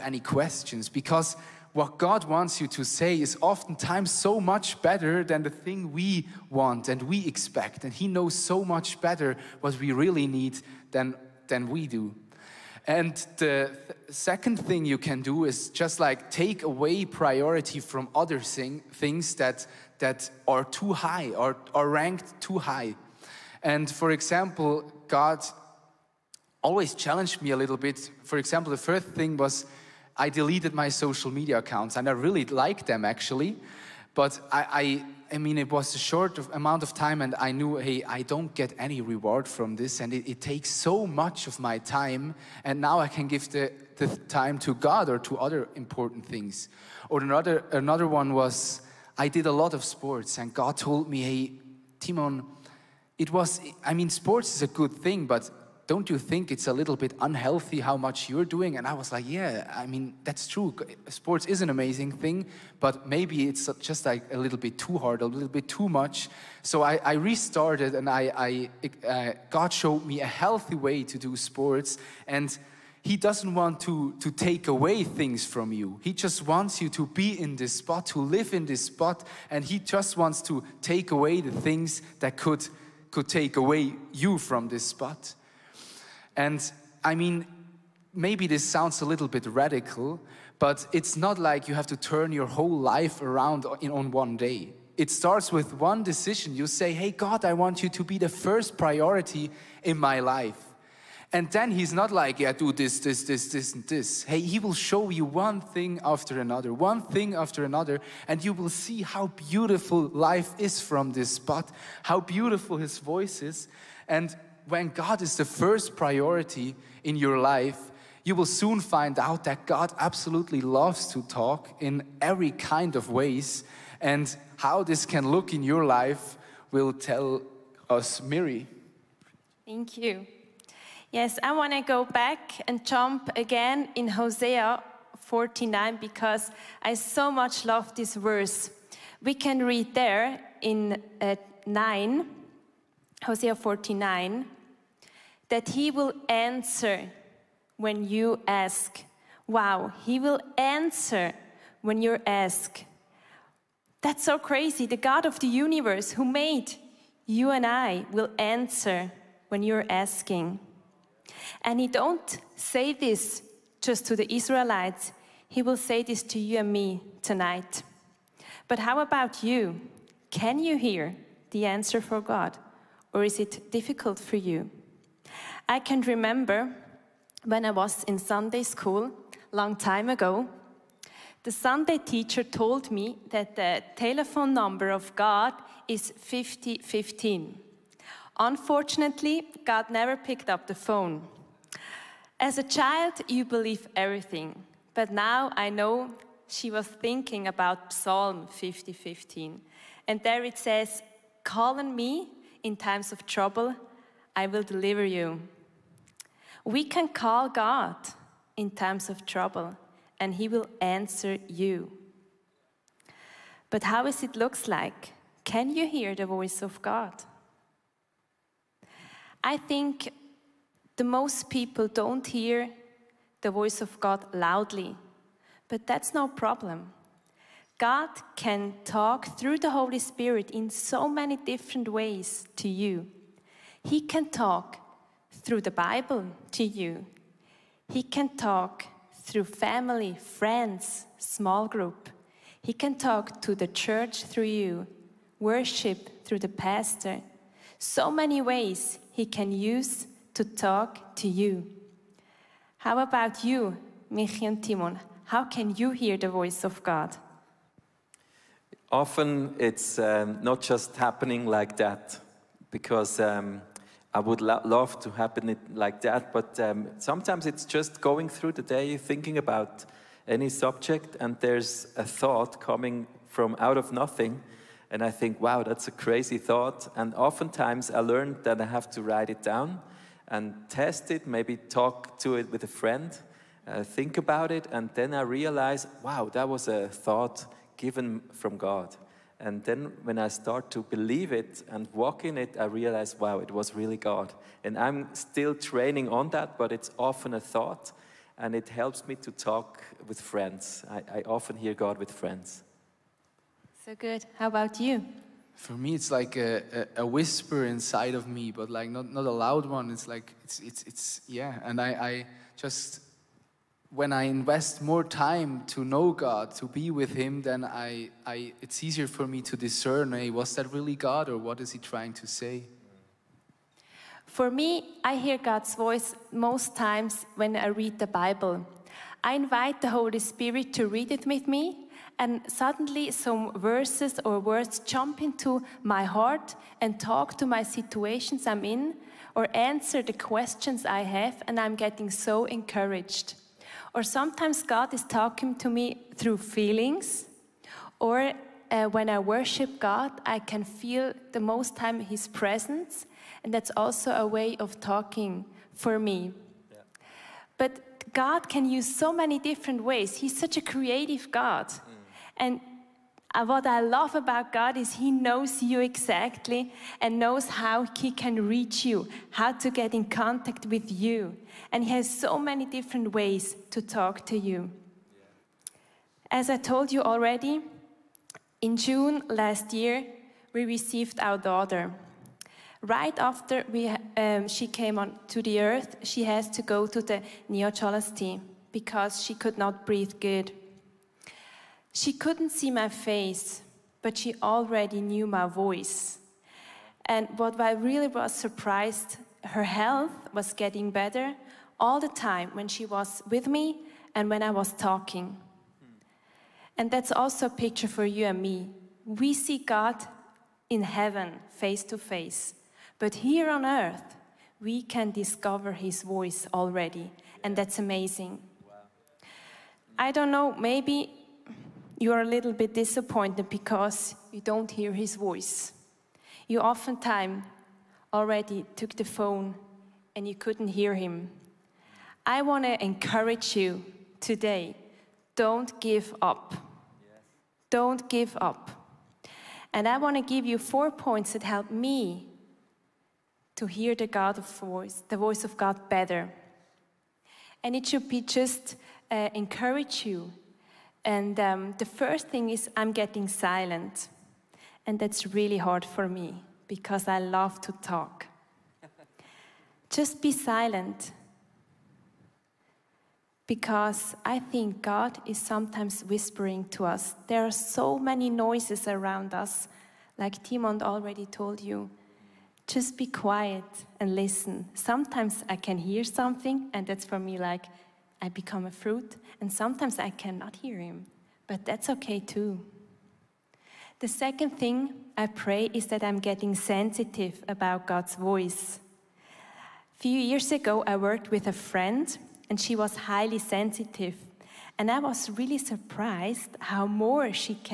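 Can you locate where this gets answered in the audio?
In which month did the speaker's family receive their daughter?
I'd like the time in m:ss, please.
6:18.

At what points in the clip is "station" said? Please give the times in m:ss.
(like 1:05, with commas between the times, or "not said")
not said.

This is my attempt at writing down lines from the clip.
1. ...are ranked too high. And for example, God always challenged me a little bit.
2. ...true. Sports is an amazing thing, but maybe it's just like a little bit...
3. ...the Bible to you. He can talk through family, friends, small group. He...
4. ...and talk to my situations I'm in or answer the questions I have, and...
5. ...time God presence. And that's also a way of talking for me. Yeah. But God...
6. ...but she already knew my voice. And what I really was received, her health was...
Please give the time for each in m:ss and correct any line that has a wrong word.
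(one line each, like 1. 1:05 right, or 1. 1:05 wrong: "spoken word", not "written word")
1. 0:21 right
2. 1:00 right
3. 3:55 right
4. 5:36 right
5. 5:51 wrong: "His", not "God"
6. 6:34 wrong: "surprised", not "received".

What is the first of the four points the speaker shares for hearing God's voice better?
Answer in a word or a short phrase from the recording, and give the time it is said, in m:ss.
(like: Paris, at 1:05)
getting silent, at 7:32.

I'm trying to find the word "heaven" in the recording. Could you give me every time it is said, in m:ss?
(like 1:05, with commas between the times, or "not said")
6:50.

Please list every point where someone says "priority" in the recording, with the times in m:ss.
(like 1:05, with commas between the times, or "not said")
0:17, 1:38, 1:55.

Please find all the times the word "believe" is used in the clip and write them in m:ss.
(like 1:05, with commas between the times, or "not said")
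3:13, 4:50.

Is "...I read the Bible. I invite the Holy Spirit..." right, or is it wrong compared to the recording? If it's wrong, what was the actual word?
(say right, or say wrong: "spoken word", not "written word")
right.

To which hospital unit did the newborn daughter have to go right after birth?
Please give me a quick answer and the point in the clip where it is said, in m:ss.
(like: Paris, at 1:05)
neonatology, at 6:27.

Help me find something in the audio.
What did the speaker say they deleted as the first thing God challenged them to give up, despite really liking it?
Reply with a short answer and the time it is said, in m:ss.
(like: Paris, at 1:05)
social media accounts, at 0:30.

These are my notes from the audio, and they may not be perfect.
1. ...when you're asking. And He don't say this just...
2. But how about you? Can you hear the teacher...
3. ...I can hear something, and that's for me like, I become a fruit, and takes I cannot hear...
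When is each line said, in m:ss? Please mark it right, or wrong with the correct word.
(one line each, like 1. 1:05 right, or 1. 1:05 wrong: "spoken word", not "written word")
1. 2:39 right
2. 2:48 wrong: "answer", not "teacher"
3. 7:55 wrong: "sometimes", not "takes".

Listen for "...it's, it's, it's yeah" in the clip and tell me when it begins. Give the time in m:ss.
5:10.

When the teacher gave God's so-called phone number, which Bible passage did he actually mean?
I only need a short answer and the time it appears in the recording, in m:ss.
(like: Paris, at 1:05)
Psalm 50:15, at 3:17.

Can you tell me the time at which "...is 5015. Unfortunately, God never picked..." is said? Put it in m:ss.
3:05.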